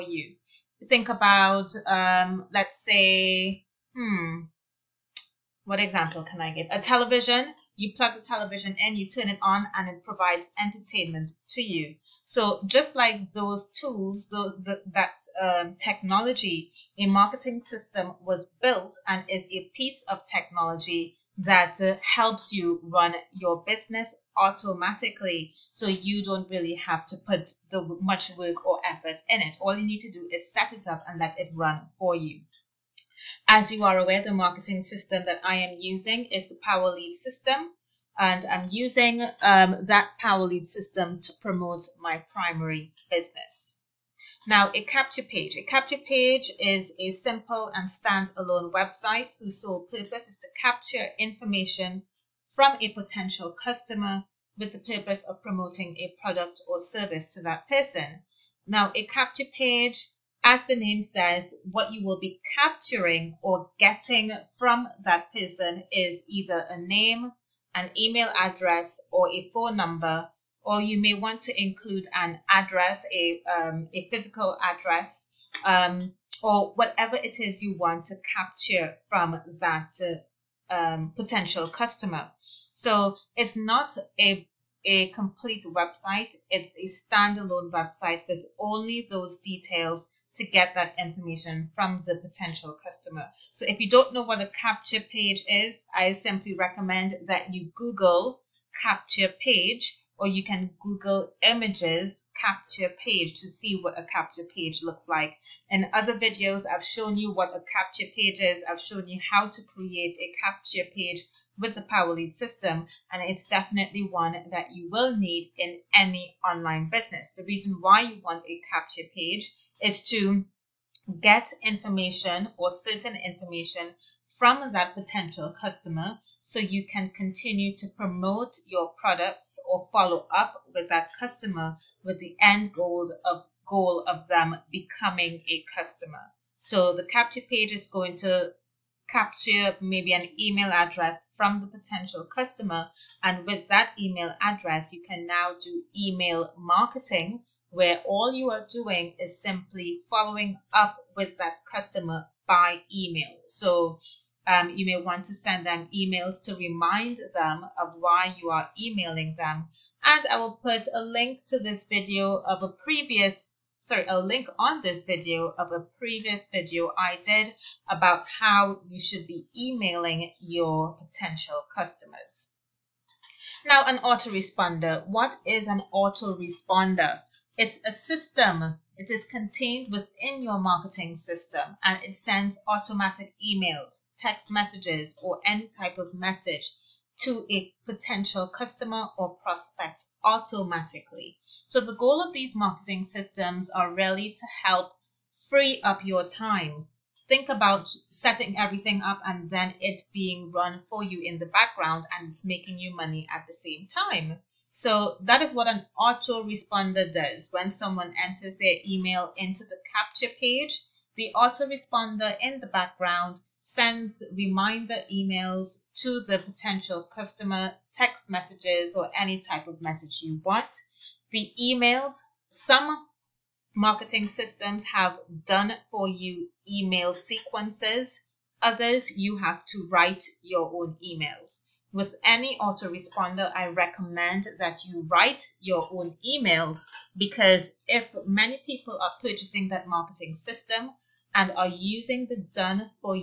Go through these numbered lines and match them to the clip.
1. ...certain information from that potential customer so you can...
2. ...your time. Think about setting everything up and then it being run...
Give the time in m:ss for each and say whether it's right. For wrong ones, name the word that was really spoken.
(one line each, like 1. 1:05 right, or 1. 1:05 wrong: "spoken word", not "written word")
1. 2:02 right
2. 3:16 right.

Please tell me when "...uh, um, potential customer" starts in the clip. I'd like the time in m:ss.
1:20.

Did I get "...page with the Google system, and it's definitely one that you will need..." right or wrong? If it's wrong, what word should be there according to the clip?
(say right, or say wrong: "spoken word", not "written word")
wrong: "PowerLead", not "Google".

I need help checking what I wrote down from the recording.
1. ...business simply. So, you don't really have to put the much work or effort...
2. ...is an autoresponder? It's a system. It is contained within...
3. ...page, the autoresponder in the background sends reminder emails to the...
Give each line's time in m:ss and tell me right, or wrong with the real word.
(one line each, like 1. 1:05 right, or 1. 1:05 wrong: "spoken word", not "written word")
1. 0:23 wrong: "automatically", not "simply"
2. 2:55 right
3. 3:30 right.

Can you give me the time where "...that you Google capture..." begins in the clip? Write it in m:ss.
1:37.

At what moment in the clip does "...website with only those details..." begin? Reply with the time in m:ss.
1:27.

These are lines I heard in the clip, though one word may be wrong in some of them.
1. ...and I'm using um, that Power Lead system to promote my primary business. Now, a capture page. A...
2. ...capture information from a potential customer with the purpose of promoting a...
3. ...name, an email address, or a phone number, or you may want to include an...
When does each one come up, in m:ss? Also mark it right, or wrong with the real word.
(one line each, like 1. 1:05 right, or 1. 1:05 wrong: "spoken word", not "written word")
1. 0:38 right
2. 0:50 right
3. 1:06 right.